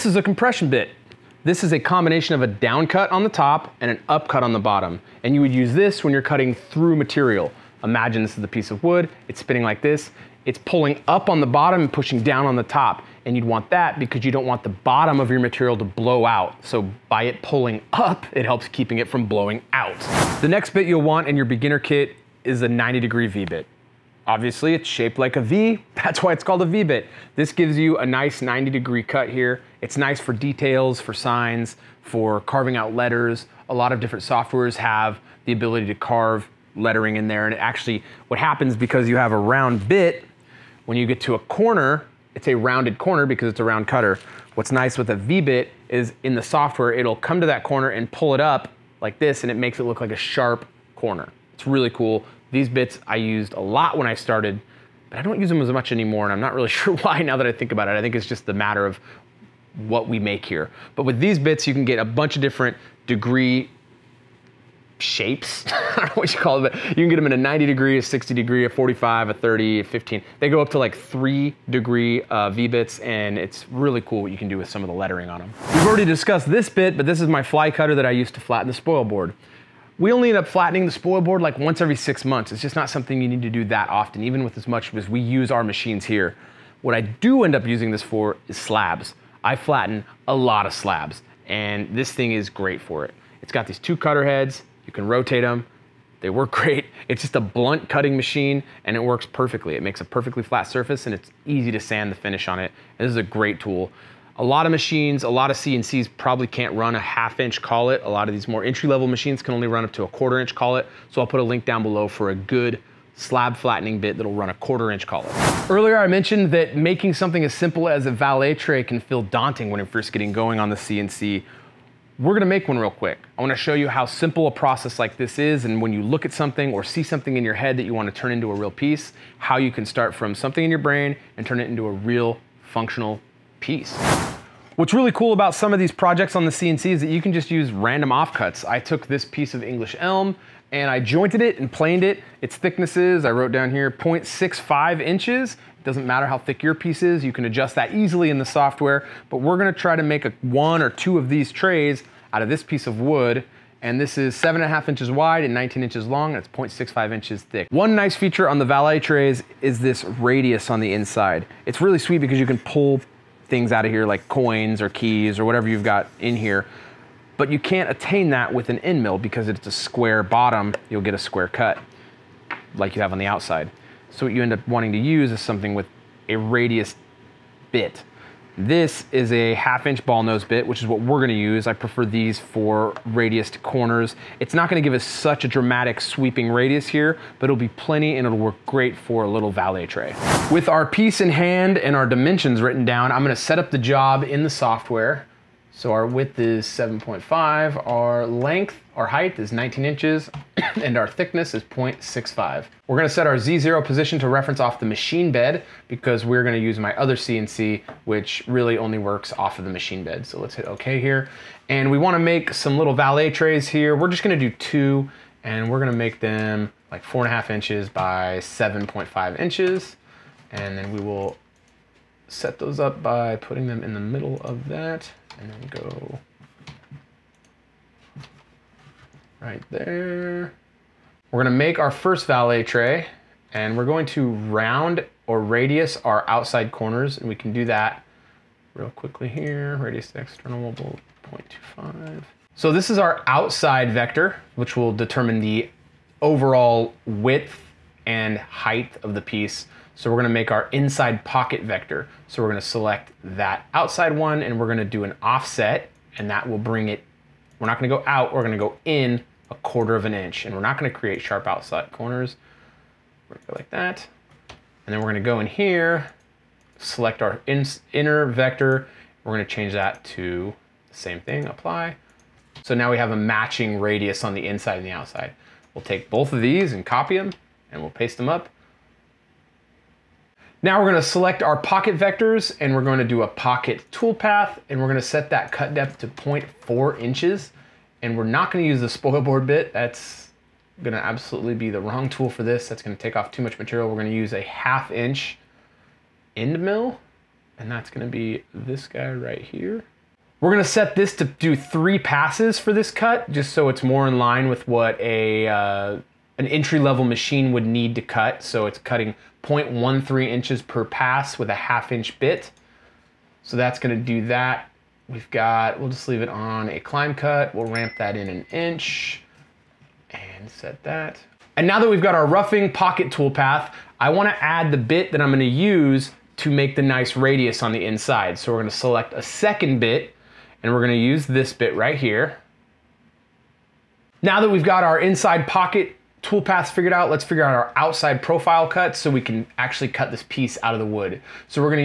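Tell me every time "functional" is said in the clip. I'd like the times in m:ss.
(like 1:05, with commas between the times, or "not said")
2:12.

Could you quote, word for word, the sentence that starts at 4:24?
And then we're gonna go in here, select our in, inner vector.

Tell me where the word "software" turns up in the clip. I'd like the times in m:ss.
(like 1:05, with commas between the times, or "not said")
0:34, 0:46, 2:28, 3:14.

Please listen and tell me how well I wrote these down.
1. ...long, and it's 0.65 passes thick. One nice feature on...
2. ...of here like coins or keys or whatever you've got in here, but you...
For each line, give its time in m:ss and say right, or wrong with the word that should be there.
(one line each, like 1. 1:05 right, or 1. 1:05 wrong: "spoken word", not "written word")
1. 2:36 wrong: "inches", not "passes"
2. 2:43 right.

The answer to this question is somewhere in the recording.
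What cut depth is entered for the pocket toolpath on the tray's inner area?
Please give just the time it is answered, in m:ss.
4:46.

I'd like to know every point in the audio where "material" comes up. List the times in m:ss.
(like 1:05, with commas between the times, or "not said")
0:06, 0:15, 4:53.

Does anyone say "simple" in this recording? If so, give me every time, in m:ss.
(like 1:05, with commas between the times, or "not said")
1:57, 2:04.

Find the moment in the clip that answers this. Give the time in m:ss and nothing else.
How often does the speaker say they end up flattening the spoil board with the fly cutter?
1:21.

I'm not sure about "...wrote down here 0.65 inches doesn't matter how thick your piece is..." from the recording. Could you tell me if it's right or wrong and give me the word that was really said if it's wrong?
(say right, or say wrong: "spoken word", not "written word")
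right.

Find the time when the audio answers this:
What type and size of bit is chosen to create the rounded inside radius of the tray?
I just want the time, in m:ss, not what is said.
2:59.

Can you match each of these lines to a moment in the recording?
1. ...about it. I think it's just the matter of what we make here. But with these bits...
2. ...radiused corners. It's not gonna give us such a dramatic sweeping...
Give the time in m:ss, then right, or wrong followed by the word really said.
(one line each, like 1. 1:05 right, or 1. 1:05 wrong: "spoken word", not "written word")
1. 0:57 right
2. 3:03 right.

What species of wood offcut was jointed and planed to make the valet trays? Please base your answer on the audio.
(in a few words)
English elm.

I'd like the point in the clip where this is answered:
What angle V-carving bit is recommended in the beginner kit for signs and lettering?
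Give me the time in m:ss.
0:22.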